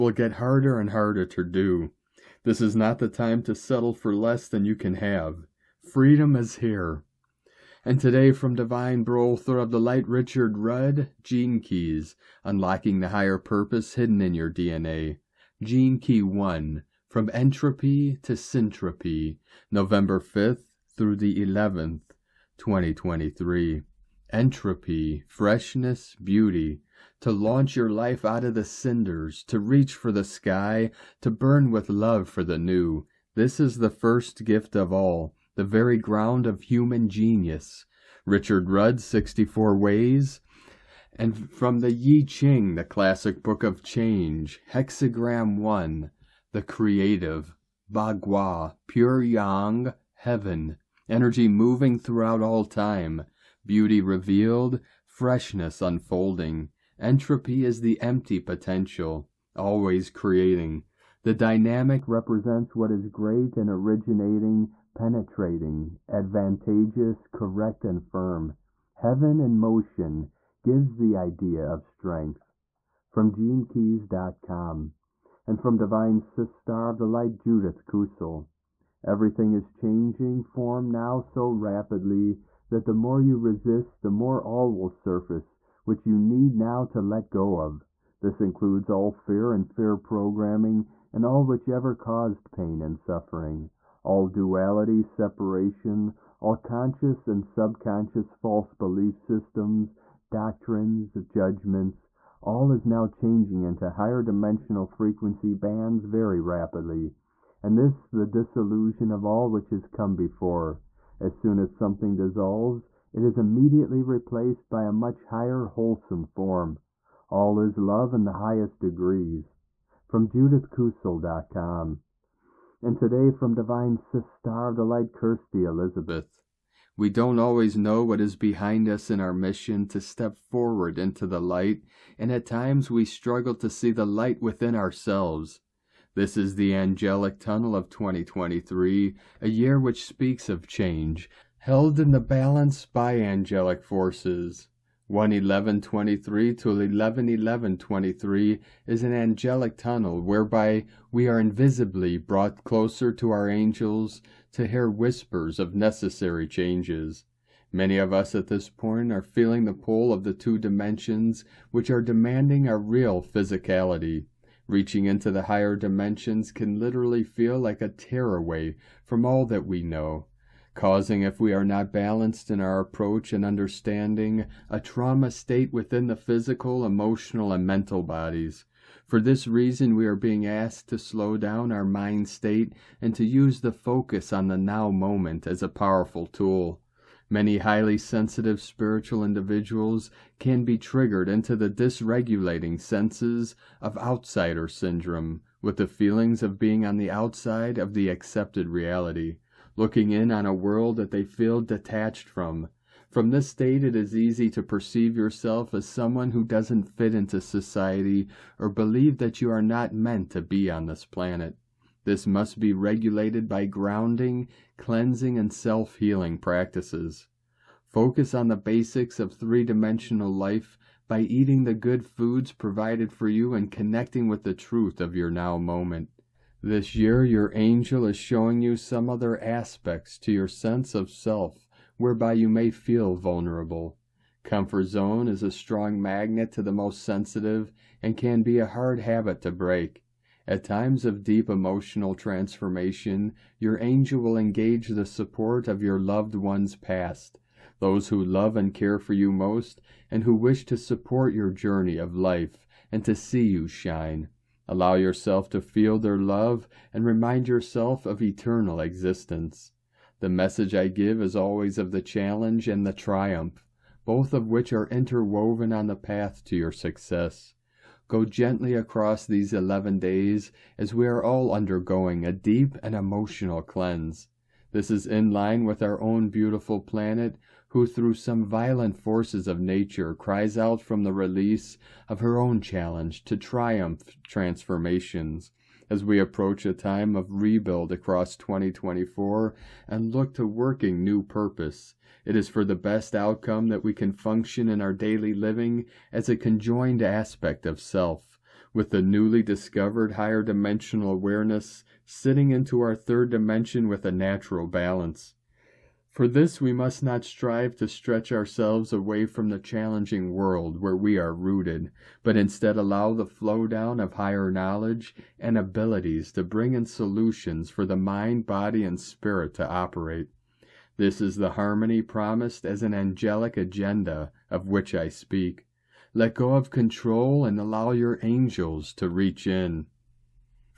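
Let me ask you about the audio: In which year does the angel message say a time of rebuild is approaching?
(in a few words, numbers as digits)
2024.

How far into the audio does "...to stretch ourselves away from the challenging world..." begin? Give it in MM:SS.
05:07.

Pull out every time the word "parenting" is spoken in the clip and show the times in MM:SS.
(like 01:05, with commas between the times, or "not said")
not said.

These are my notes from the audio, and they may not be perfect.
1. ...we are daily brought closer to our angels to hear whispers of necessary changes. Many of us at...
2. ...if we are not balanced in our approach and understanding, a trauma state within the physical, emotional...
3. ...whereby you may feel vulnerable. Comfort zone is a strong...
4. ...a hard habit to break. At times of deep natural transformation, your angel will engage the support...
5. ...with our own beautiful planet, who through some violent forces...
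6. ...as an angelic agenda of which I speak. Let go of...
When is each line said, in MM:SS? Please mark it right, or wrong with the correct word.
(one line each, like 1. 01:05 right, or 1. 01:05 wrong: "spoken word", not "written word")
1. 02:31 wrong: "invisibly", not "daily"
2. 02:51 right
3. 03:51 right
4. 03:58 wrong: "emotional", not "natural"
5. 04:35 right
6. 05:22 right.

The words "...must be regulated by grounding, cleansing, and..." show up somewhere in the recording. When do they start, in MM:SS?
03:32.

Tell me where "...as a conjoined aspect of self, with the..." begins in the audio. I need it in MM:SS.
04:56.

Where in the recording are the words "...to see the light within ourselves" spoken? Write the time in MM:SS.
02:13.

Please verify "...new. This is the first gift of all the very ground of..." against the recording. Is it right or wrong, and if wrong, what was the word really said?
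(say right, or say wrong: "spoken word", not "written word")
right.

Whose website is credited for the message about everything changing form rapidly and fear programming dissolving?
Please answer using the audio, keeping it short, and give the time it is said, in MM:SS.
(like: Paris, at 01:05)
Judith Kusel, at 01:17.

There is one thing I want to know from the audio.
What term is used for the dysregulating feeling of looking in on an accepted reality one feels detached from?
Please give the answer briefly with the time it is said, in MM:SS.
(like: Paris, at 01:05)
outsider syndrome, at 03:13.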